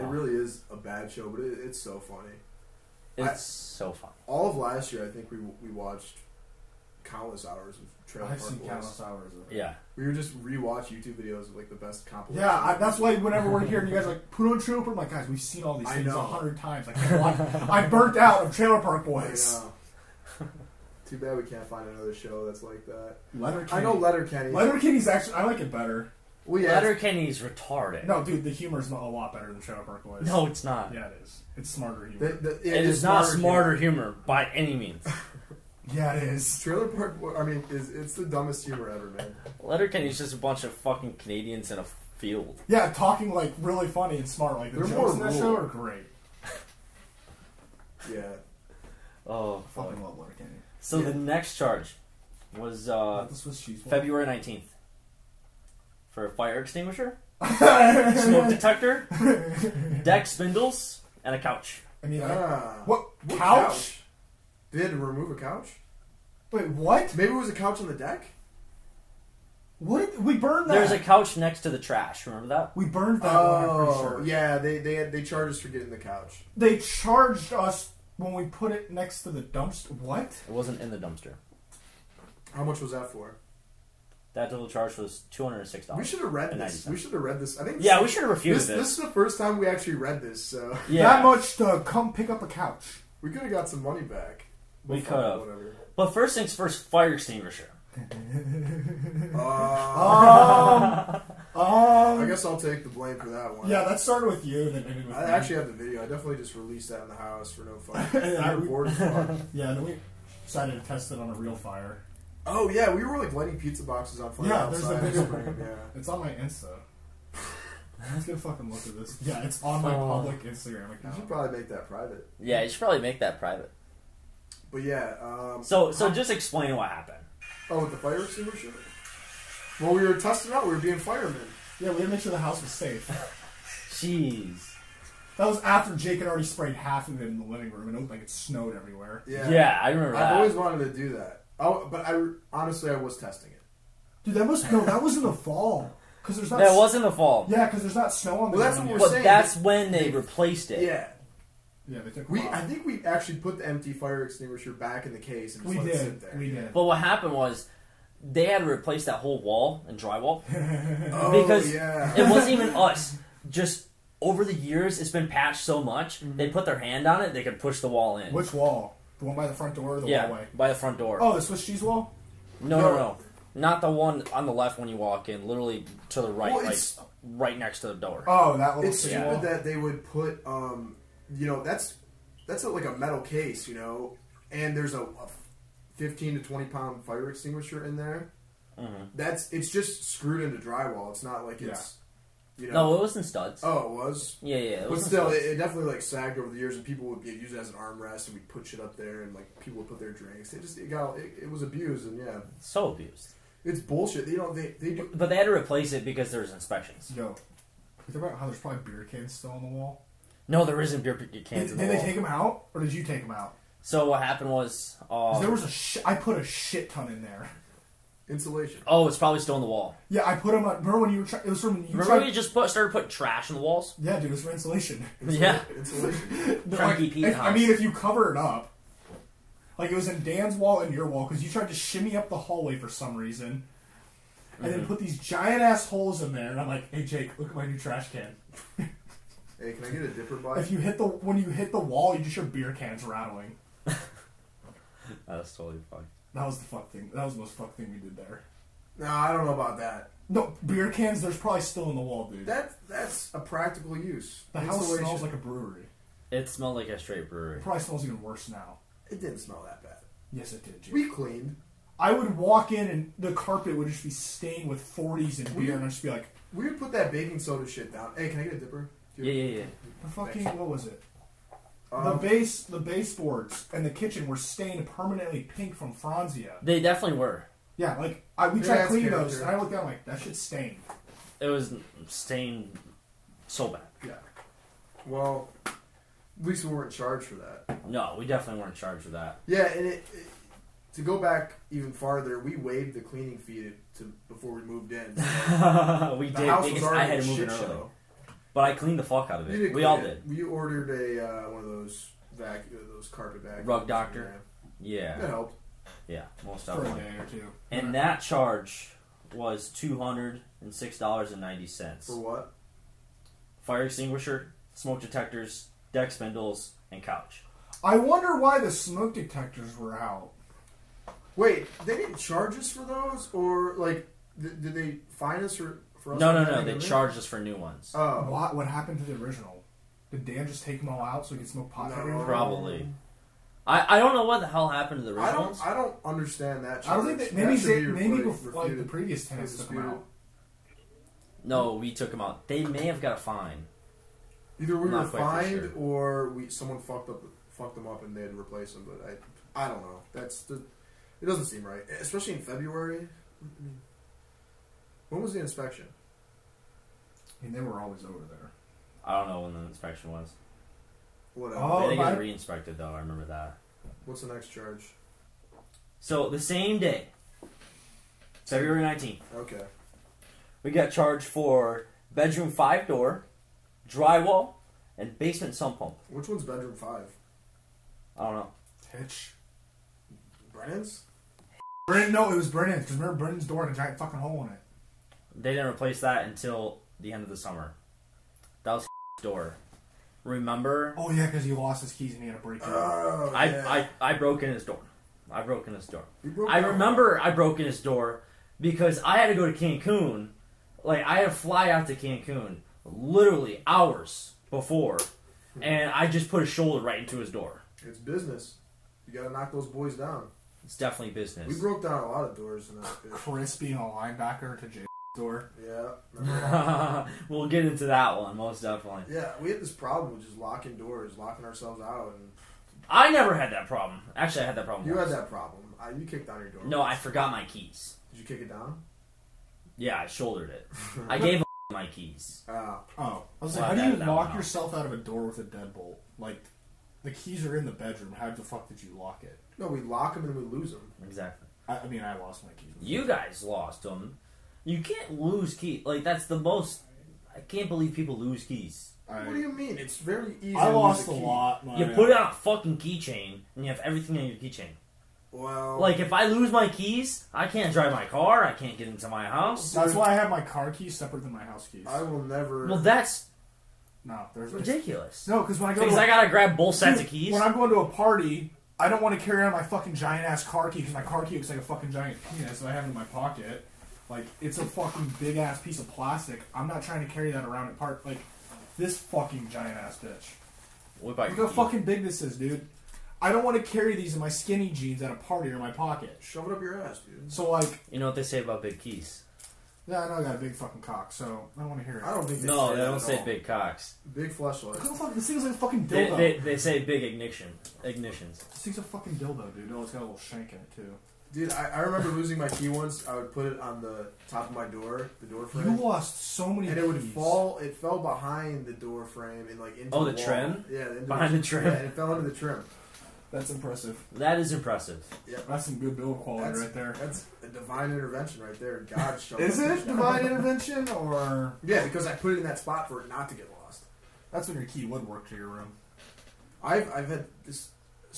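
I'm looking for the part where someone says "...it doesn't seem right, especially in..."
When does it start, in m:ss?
5:51.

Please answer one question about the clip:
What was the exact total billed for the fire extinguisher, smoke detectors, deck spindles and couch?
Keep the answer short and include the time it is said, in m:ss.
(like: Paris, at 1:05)
$206.90, at 5:09.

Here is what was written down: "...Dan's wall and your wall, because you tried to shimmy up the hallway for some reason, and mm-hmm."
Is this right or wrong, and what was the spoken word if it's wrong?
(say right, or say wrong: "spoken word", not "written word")
right.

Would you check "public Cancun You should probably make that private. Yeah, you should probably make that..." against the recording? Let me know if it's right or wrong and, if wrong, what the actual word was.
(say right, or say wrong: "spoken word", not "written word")
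wrong: "Instagram", not "Cancun".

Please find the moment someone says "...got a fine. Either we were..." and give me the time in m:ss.
5:42.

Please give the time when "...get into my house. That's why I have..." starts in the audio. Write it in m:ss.
7:38.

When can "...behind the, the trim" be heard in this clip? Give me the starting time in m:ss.
8:31.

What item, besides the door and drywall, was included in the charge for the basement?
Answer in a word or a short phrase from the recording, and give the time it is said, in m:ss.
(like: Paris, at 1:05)
sump pump, at 6:15.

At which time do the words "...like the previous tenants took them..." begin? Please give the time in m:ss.
5:38.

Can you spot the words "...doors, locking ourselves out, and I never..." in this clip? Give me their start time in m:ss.
7:00.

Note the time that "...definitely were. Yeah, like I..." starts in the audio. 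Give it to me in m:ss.
4:36.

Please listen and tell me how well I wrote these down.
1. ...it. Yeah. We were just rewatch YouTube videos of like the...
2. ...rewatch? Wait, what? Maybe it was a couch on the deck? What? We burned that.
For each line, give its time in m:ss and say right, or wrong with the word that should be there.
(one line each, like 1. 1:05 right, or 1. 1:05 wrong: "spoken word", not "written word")
1. 0:09 right
2. 1:05 wrong: "couch", not "rewatch".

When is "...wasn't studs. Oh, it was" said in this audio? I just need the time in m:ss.
3:12.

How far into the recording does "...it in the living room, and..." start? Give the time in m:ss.
2:17.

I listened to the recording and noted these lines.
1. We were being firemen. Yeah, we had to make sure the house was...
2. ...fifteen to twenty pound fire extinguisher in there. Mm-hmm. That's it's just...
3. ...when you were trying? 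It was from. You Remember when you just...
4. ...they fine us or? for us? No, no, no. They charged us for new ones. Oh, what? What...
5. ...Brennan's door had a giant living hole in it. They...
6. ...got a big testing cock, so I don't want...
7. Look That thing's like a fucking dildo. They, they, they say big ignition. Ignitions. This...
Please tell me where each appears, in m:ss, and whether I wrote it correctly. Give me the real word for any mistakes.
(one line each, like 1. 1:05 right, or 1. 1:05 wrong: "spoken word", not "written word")
1. 2:10 right
2. 3:05 right
3. 3:40 right
4. 5:24 right
5. 6:23 wrong: "fucking", not "living"
6. 8:10 wrong: "fucking", not "testing"
7. 8:14 wrong: "This", not "That".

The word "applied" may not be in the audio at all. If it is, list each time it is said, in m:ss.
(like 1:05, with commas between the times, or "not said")
not said.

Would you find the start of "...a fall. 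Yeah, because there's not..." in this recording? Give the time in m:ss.
2:27.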